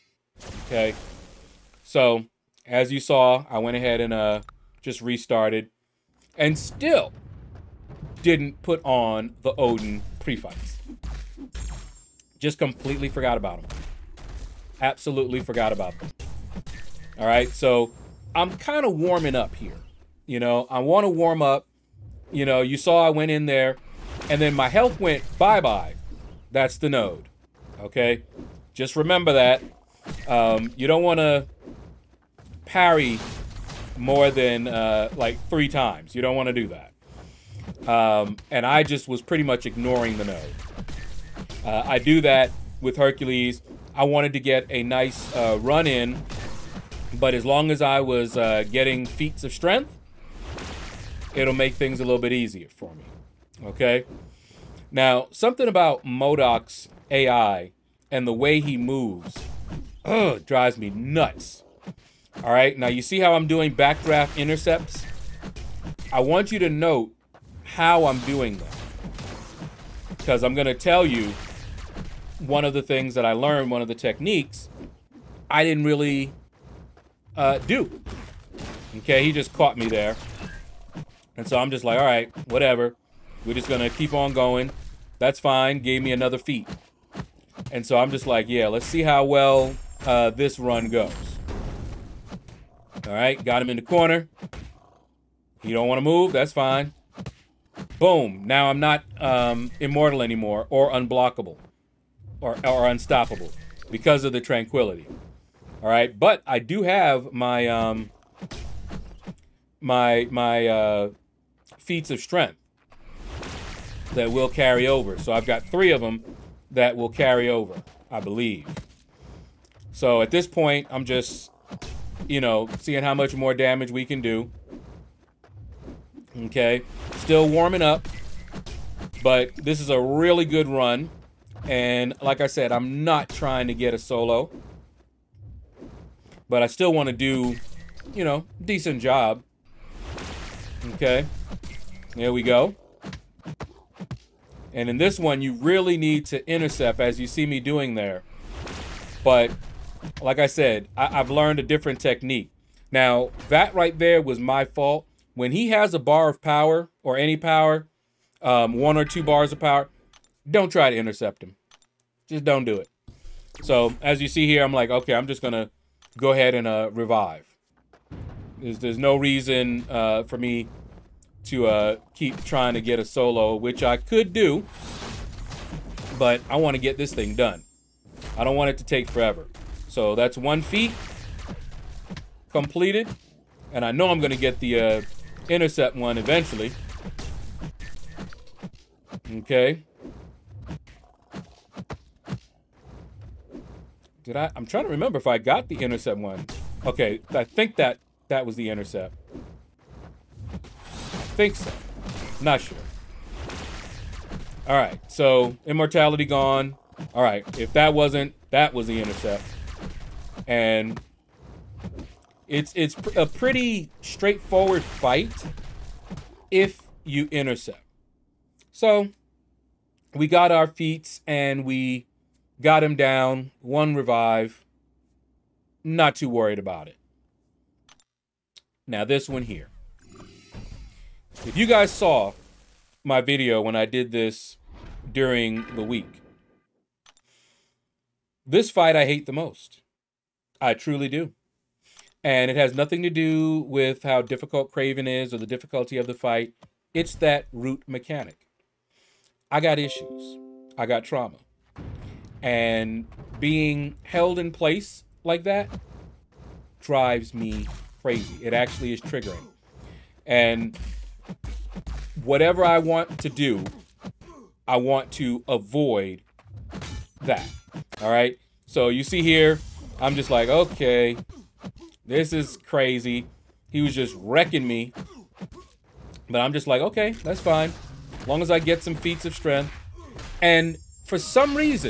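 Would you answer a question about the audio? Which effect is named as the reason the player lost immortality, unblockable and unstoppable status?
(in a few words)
tranquility.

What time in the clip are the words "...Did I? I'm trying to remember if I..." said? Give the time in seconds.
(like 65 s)
194 s.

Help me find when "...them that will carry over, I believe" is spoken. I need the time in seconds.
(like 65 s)
115 s.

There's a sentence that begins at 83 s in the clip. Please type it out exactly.
We're just going to keep on going.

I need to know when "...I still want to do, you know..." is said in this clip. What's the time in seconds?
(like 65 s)
136 s.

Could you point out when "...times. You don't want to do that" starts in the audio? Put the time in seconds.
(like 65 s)
35 s.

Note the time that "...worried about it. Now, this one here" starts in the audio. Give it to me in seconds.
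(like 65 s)
226 s.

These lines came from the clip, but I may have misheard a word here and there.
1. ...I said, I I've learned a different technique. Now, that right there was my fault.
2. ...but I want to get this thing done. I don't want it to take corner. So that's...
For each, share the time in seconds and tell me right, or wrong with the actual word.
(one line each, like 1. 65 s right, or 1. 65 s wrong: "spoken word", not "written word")
1. 150 s right
2. 176 s wrong: "forever", not "corner".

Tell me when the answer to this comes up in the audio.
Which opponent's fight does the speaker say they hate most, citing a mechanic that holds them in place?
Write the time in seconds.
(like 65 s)
244 s.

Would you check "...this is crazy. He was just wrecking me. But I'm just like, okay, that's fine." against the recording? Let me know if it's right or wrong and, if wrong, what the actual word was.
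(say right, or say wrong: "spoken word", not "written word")
right.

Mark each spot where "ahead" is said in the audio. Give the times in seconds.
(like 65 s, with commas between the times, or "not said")
3 s, 166 s.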